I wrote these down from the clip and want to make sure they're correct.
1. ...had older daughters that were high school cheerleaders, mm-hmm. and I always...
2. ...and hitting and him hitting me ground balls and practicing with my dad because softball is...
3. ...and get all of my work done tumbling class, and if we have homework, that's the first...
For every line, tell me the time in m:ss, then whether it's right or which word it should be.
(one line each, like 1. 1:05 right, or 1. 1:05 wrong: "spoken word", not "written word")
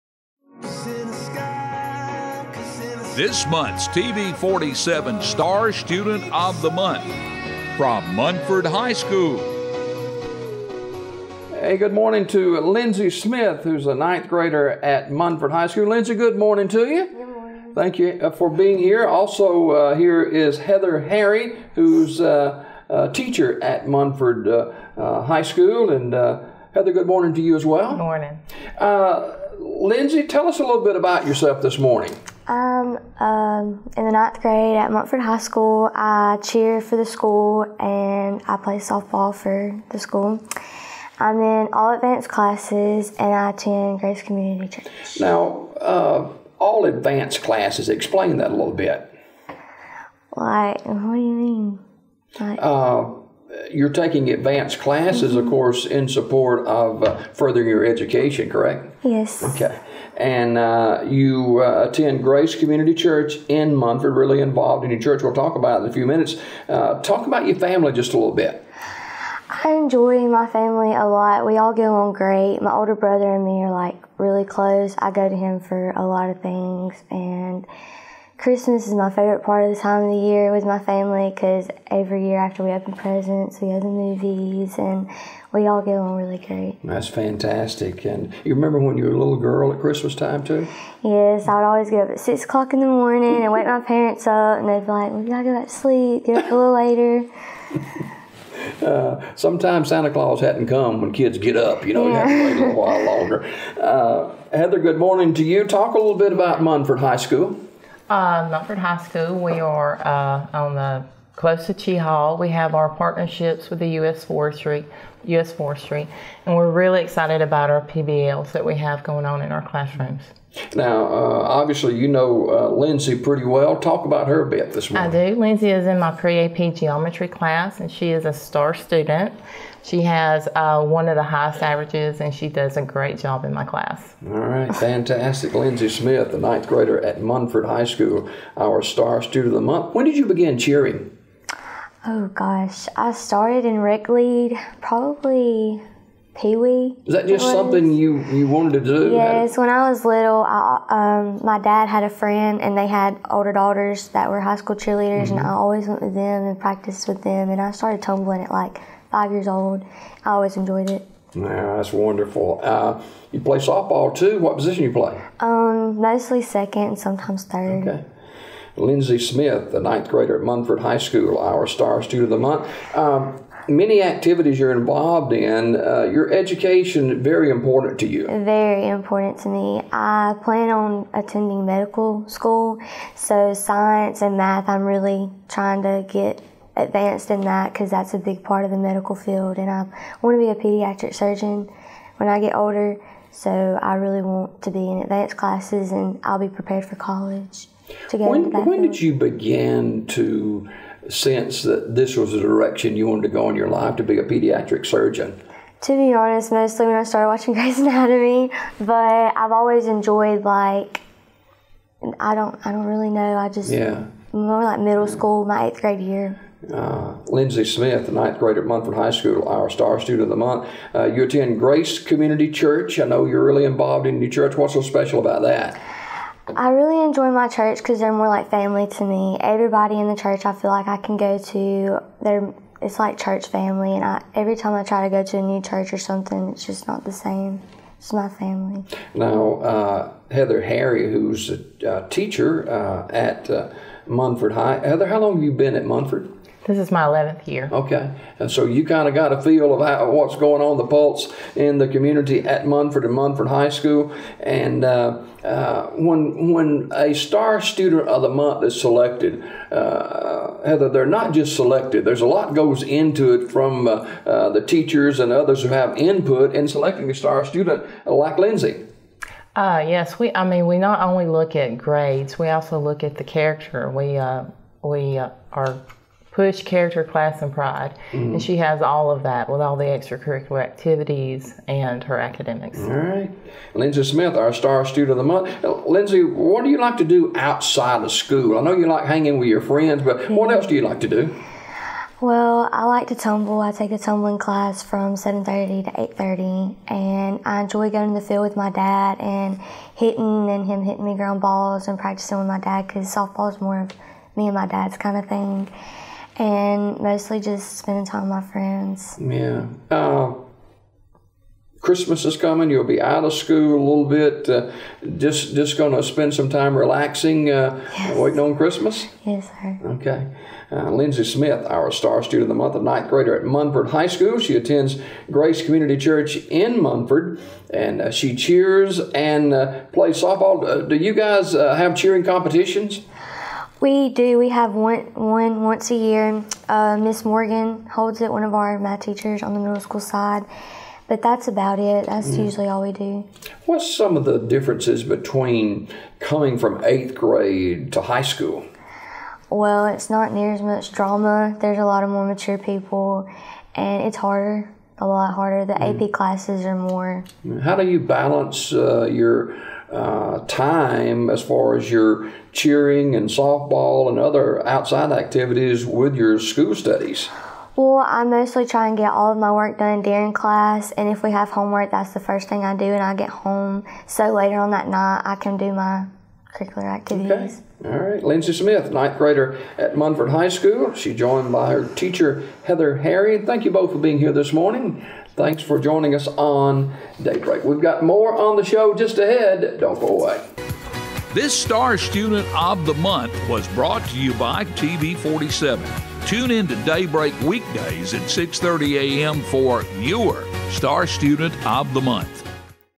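1. 2:32 right
2. 4:59 right
3. 6:08 wrong: "during", not "tumbling".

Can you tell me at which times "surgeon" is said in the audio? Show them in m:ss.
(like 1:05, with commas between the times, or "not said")
3:11, 3:24.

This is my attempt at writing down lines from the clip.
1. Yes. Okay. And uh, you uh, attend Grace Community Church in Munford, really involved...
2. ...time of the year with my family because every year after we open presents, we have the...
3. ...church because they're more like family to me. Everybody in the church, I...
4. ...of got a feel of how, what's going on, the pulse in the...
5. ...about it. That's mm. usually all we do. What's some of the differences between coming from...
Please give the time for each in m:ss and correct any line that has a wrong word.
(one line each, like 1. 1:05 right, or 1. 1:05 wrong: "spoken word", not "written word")
1. 0:59 right
2. 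1:19 right
3. 3:47 right
4. 4:09 right
5. 5:41 right.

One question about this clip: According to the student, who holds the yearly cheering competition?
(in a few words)
Miss Morgan.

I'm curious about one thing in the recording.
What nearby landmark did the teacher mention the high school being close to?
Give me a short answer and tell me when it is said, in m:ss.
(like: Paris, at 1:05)
Cheaha, at 1:51.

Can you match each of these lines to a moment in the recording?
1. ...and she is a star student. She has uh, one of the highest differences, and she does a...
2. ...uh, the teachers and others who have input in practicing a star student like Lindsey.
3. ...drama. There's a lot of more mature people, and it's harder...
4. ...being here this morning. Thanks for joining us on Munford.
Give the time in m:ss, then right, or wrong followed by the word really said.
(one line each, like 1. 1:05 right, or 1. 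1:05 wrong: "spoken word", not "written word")
1. 2:07 wrong: "averages", not "differences"
2. 4:24 wrong: "selecting", not "practicing"
3. 5:50 right
4. 6:23 wrong: "Daybreak", not "Munford".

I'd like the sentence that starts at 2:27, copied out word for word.
Is that just something you, you wanted to do?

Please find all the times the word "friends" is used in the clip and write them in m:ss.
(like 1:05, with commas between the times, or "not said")
2:32, 4:49, 5:08.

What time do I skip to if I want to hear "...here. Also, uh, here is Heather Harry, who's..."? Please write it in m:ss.
0:18.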